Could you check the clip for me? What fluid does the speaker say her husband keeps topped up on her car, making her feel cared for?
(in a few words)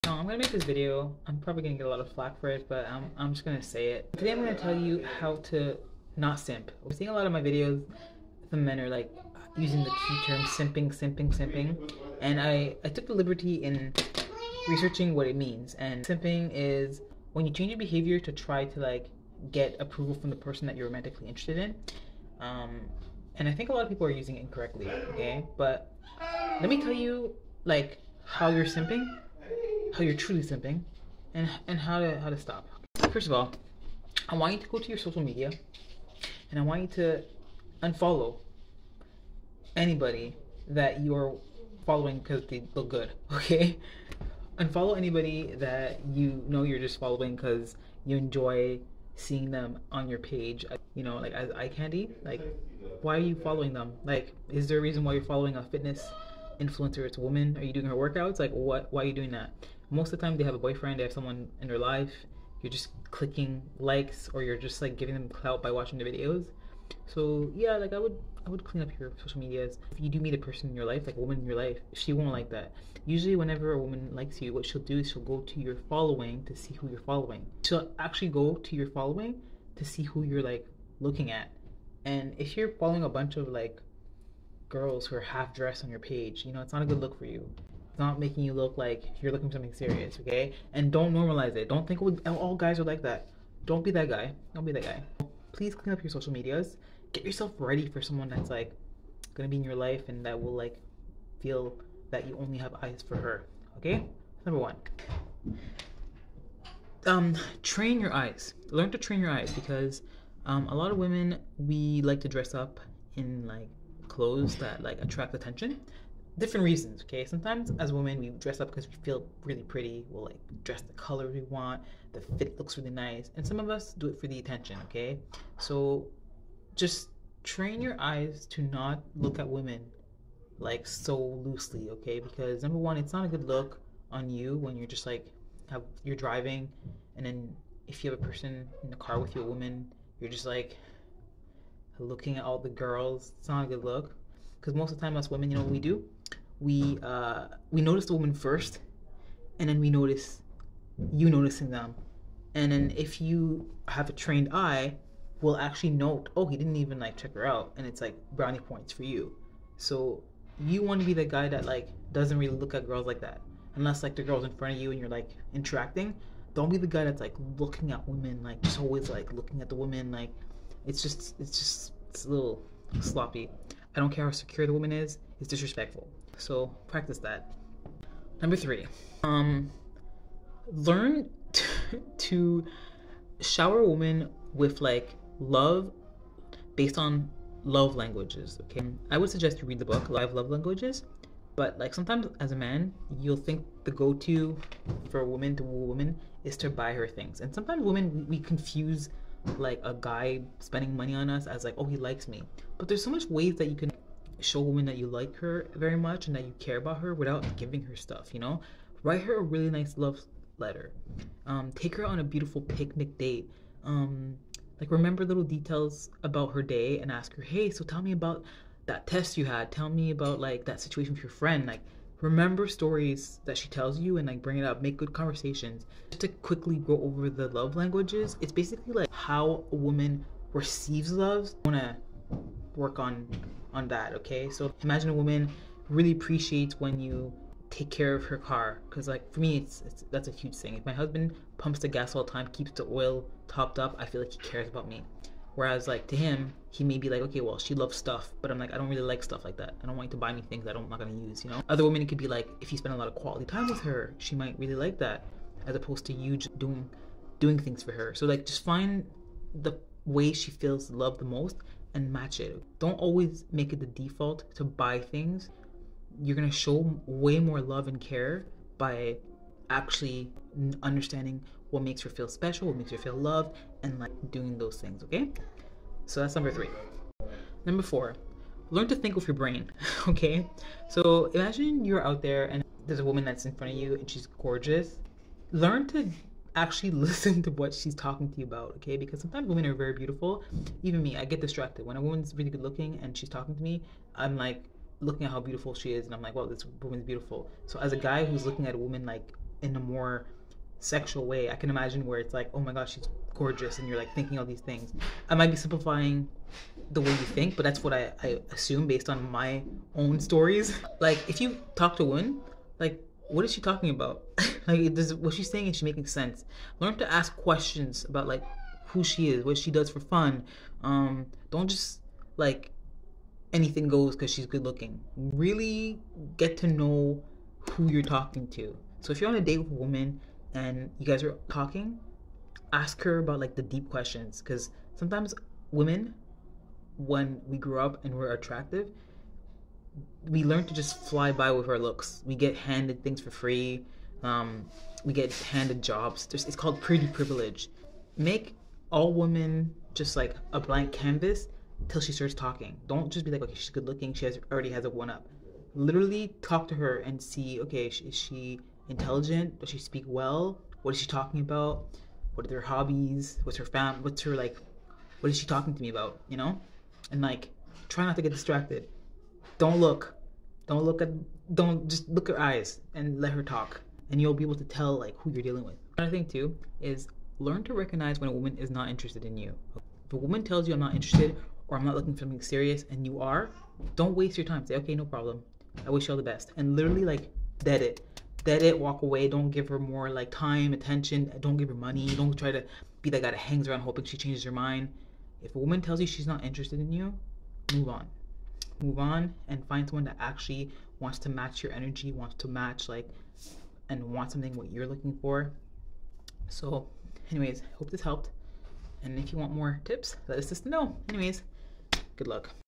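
oil.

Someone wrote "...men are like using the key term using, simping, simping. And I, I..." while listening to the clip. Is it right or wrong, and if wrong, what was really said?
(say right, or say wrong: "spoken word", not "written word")
wrong: "simping", not "using".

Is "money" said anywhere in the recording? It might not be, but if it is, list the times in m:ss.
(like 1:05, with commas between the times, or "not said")
3:20, 6:31.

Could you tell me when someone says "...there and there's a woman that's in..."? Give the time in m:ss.
4:42.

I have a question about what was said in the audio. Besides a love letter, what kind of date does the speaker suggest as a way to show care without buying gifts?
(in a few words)
picnic date.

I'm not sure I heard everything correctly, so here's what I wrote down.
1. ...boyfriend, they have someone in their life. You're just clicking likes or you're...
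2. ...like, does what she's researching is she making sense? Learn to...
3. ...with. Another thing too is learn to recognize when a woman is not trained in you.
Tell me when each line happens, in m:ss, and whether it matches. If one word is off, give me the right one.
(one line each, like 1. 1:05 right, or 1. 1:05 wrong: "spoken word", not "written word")
1. 1:00 right
2. 5:14 wrong: "saying", not "researching"
3. 6:15 wrong: "interested", not "trained".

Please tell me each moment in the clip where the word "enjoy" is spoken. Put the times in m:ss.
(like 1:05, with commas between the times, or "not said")
0:48.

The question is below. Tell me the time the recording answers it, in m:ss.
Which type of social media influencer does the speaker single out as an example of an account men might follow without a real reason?
0:55.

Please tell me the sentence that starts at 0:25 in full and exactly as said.
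But let me tell you like how you're simping how you're truly simping and and how to how to stop.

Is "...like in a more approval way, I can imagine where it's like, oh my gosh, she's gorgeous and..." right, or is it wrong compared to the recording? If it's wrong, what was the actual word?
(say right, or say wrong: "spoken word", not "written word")
wrong: "sexual", not "approval".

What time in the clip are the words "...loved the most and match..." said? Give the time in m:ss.
4:20.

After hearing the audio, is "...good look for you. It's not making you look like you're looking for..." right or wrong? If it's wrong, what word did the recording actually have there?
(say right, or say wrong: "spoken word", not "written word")
right.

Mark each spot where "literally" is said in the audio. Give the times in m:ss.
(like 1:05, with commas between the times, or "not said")
5:55, 6:26.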